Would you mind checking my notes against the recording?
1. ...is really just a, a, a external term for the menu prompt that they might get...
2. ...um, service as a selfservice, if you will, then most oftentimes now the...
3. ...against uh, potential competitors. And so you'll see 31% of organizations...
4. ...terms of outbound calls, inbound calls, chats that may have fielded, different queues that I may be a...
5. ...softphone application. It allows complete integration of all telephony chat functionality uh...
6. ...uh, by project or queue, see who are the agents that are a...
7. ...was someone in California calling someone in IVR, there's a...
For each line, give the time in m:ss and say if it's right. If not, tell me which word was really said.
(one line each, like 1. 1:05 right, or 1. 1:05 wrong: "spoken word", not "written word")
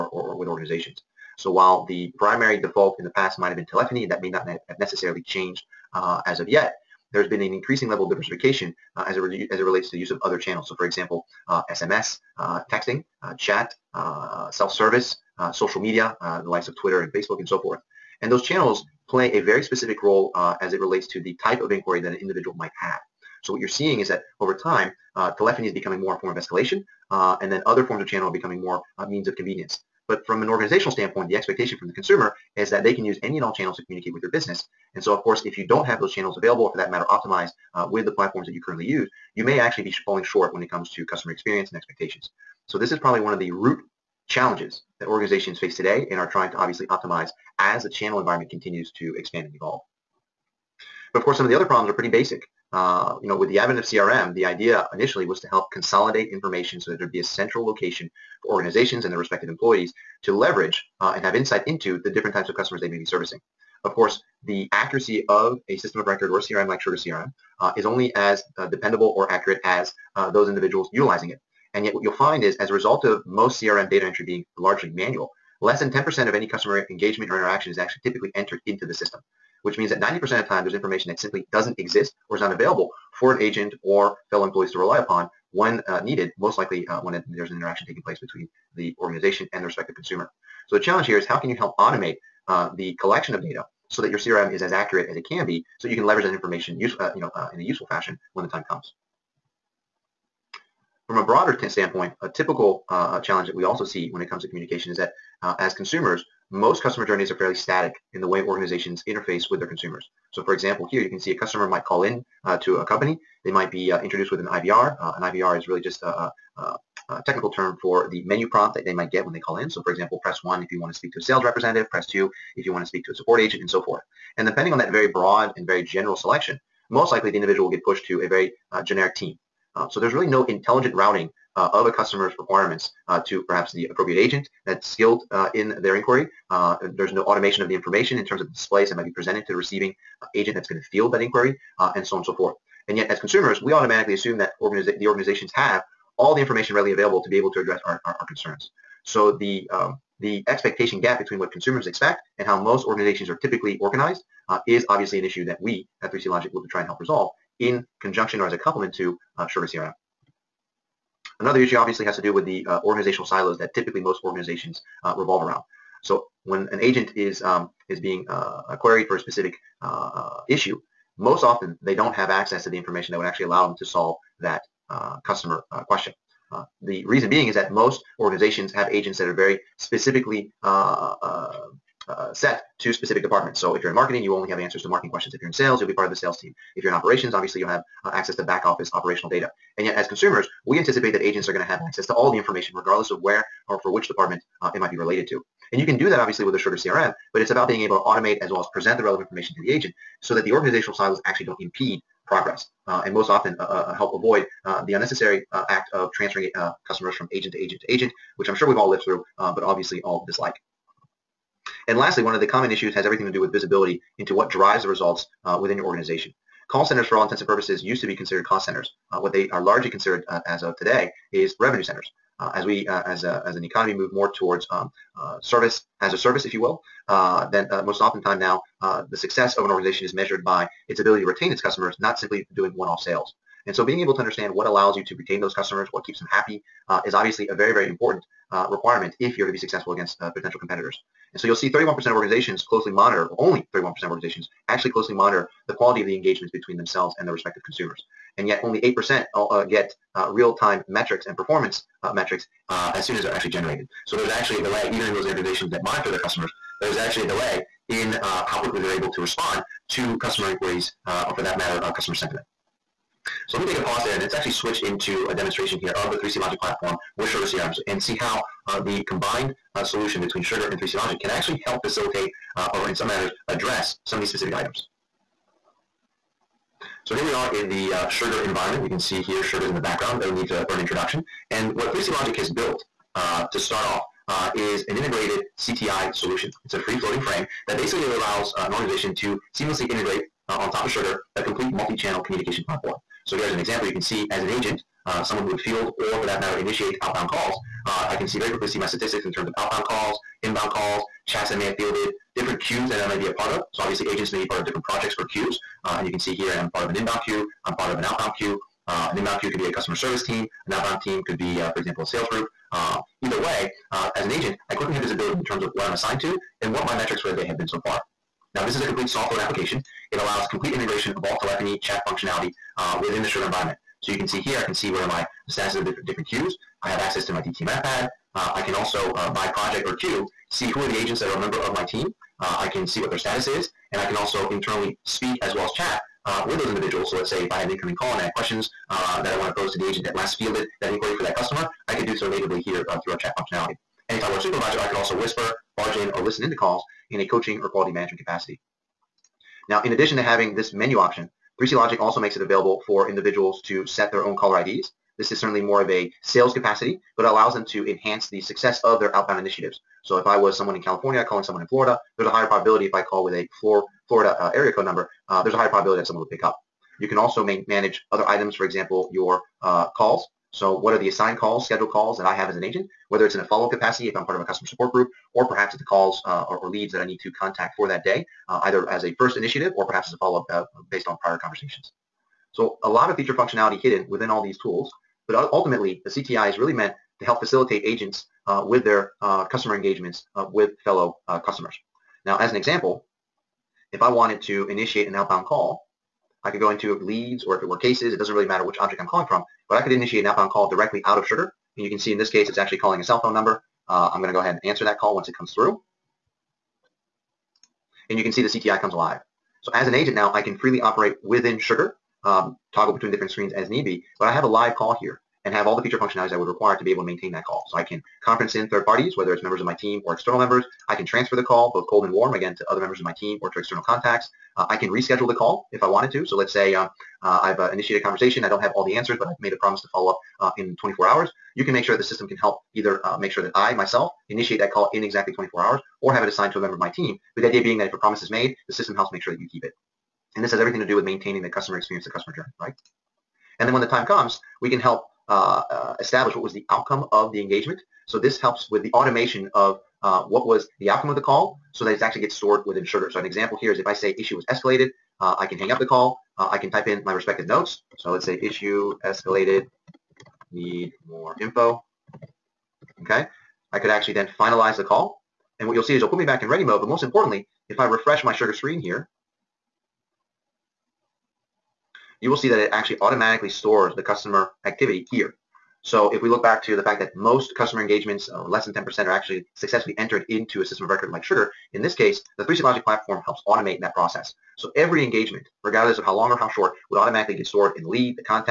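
1. 1:55 wrong: "technical", not "external"
2. 3:44 wrong: "service", not "selfservice"
3. 3:59 right
4. 4:59 right
5. 5:19 right
6. 5:29 right
7. 6:00 wrong: "Florida", not "IVR".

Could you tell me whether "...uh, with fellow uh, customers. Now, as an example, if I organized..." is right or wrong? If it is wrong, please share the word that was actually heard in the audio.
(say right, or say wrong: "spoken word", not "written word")
wrong: "wanted", not "organized".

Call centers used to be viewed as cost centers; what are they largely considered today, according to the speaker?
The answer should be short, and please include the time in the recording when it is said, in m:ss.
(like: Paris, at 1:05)
revenue centers, at 3:41.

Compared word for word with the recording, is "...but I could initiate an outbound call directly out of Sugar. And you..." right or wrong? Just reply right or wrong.
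right.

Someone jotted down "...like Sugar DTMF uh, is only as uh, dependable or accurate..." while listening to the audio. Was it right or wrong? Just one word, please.
wrong.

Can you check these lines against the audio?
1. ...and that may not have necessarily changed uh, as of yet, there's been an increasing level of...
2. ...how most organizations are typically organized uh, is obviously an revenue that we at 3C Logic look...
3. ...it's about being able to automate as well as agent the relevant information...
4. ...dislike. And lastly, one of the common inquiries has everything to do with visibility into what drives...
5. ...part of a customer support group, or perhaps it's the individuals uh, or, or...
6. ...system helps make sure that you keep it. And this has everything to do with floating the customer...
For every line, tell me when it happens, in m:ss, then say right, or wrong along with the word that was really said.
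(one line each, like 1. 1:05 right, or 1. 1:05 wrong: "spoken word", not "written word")
1. 0:04 right
2. 2:32 wrong: "issue", not "revenue"
3. 3:17 wrong: "present", not "agent"
4. 3:30 wrong: "issues", not "inquiries"
5. 6:14 wrong: "calls", not "individuals"
6. 7:18 wrong: "maintaining", not "floating".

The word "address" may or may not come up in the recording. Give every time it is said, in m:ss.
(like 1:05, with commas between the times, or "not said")
2:27, 4:33.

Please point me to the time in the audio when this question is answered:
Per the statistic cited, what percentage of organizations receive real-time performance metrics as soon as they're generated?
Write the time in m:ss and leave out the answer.
4:08.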